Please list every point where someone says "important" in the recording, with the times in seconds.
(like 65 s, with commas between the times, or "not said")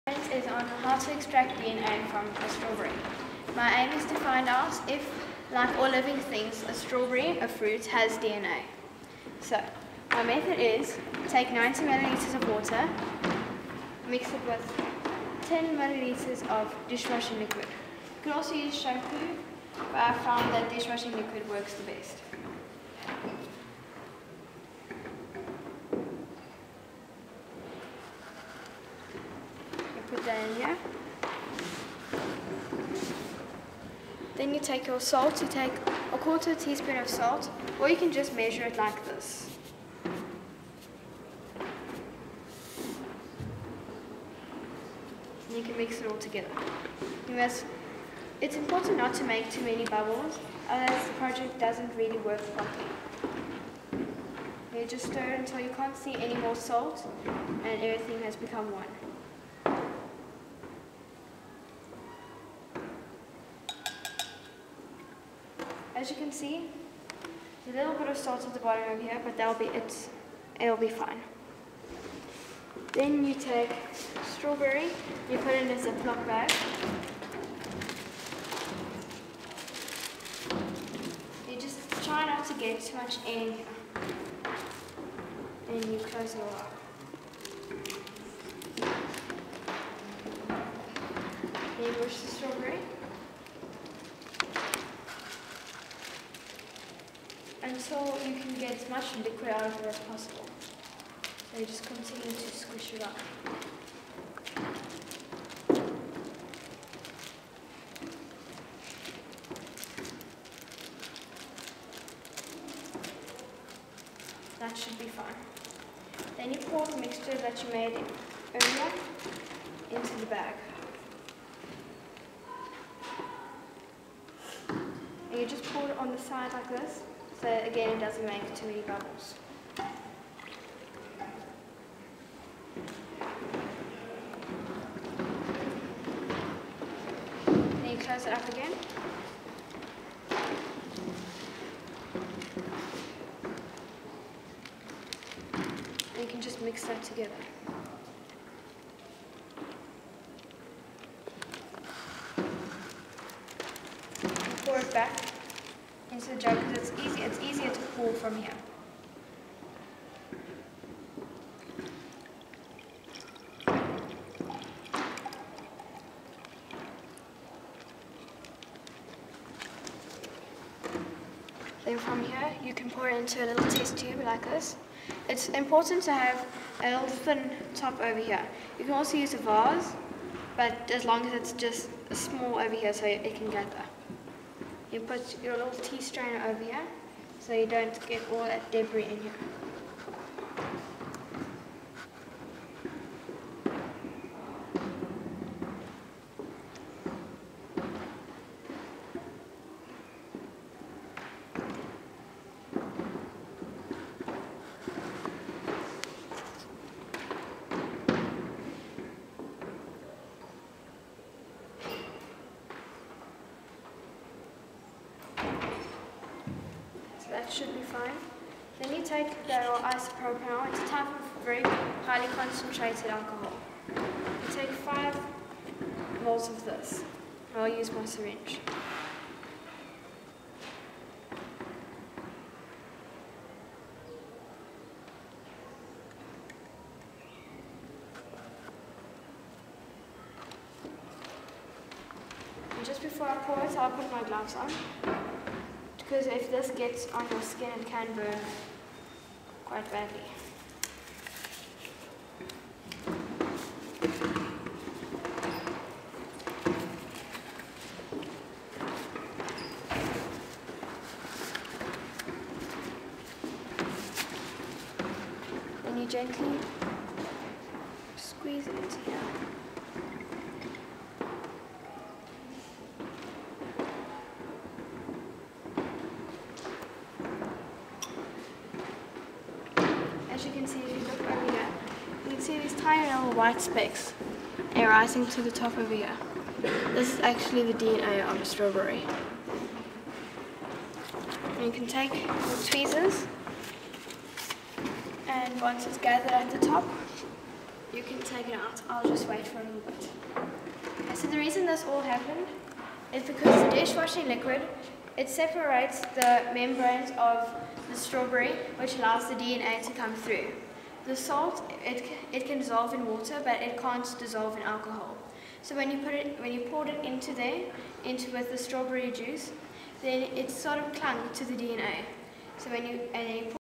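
48 s, 175 s.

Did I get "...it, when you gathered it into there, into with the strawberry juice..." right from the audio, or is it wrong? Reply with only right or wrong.
wrong.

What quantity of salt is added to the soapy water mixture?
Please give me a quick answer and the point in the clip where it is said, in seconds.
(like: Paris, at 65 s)
A quarter teaspoon, at 36 s.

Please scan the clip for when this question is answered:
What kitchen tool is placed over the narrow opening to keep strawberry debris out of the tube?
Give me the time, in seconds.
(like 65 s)
185 s.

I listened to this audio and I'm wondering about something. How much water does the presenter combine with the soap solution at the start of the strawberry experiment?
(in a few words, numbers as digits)
90 milliliters.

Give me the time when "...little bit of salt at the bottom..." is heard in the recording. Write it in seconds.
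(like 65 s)
67 s.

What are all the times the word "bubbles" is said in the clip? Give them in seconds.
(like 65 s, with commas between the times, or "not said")
49 s, 128 s.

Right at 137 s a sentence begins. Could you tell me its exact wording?
Then you close it up again.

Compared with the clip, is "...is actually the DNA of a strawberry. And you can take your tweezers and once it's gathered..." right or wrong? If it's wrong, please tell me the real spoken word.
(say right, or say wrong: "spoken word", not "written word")
right.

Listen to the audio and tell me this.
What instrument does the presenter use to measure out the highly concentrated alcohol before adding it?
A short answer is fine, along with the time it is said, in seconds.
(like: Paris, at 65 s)
Syringe, at 228 s.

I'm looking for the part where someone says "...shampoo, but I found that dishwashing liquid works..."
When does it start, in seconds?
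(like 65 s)
18 s.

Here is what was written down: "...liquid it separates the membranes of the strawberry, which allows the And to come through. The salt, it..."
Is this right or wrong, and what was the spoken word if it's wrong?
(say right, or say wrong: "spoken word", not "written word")
wrong: "DNA", not "And".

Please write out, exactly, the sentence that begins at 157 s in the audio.
It's easier to pull from here.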